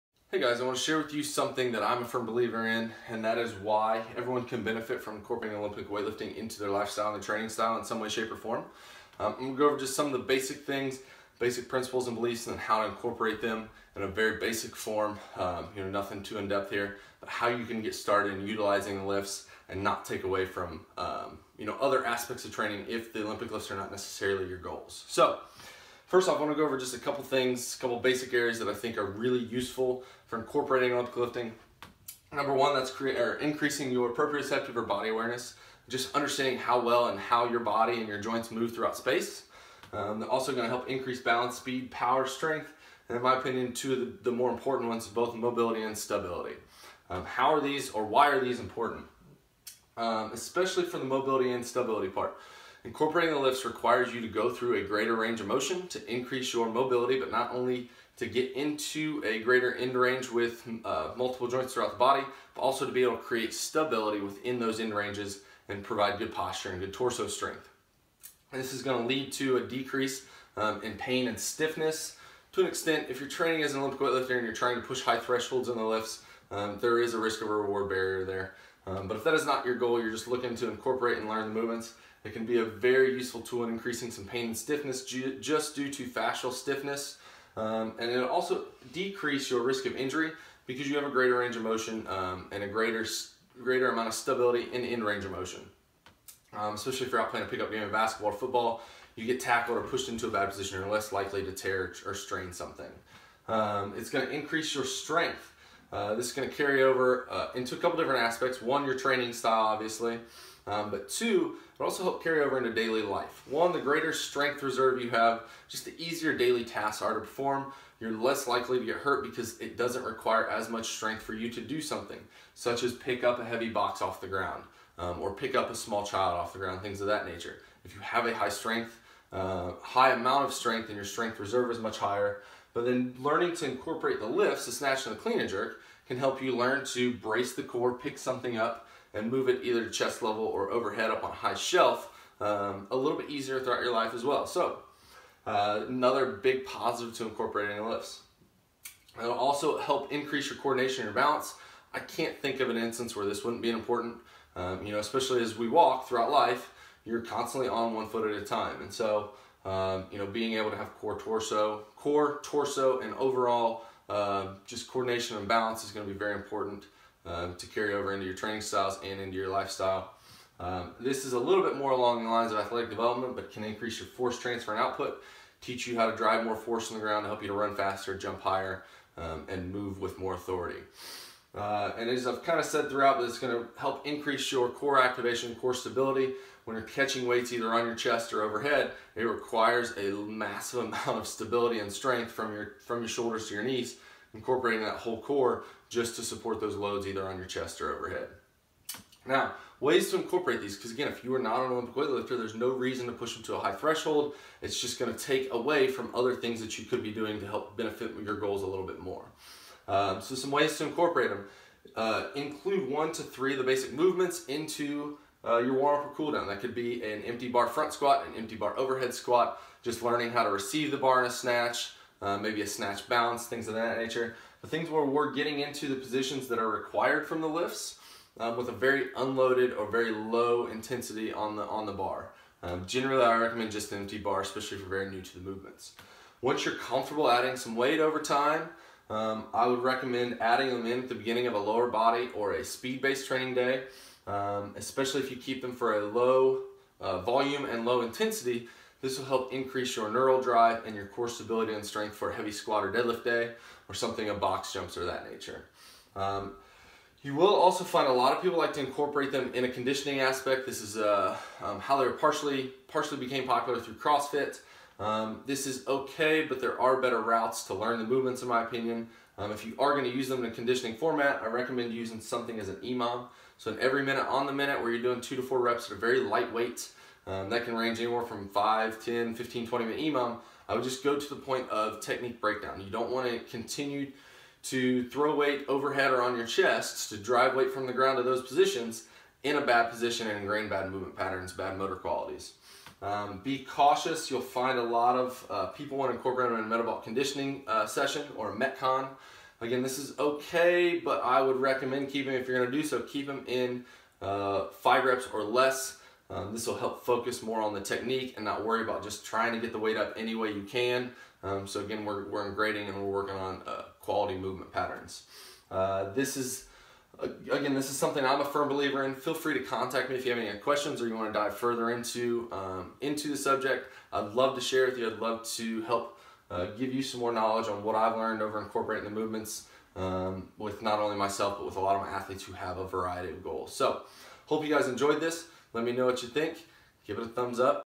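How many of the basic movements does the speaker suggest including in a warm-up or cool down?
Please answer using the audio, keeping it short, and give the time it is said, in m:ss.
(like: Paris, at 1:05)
1 to 3, at 3:32.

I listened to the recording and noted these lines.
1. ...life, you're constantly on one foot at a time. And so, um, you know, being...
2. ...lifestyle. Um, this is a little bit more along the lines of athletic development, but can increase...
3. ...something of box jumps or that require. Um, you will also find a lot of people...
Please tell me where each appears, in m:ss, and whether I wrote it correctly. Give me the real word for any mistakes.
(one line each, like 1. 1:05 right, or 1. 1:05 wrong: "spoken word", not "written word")
1. 2:36 right
2. 2:49 right
3. 4:13 wrong: "nature", not "require".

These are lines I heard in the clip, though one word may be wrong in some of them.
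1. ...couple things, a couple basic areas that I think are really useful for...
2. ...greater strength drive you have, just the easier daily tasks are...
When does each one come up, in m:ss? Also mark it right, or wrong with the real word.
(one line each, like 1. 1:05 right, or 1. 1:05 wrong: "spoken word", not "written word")
1. 0:26 right
2. 1:53 wrong: "reserve", not "drive".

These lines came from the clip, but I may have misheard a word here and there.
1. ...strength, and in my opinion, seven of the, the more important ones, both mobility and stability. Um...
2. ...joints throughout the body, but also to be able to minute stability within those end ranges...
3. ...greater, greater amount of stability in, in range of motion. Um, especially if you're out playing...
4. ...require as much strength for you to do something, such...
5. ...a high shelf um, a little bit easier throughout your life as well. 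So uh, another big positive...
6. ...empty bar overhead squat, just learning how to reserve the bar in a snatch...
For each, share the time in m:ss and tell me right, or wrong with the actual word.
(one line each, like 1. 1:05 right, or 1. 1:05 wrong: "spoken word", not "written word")
1. 0:42 wrong: "two", not "seven"
2. 1:01 wrong: "create", not "minute"
3. 1:32 right
4. 2:00 right
5. 2:21 right
6. 3:38 wrong: "receive", not "reserve".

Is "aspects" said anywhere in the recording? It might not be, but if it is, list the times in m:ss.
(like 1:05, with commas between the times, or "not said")
0:22, 1:48, 4:20.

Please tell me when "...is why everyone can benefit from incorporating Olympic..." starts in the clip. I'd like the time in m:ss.
0:03.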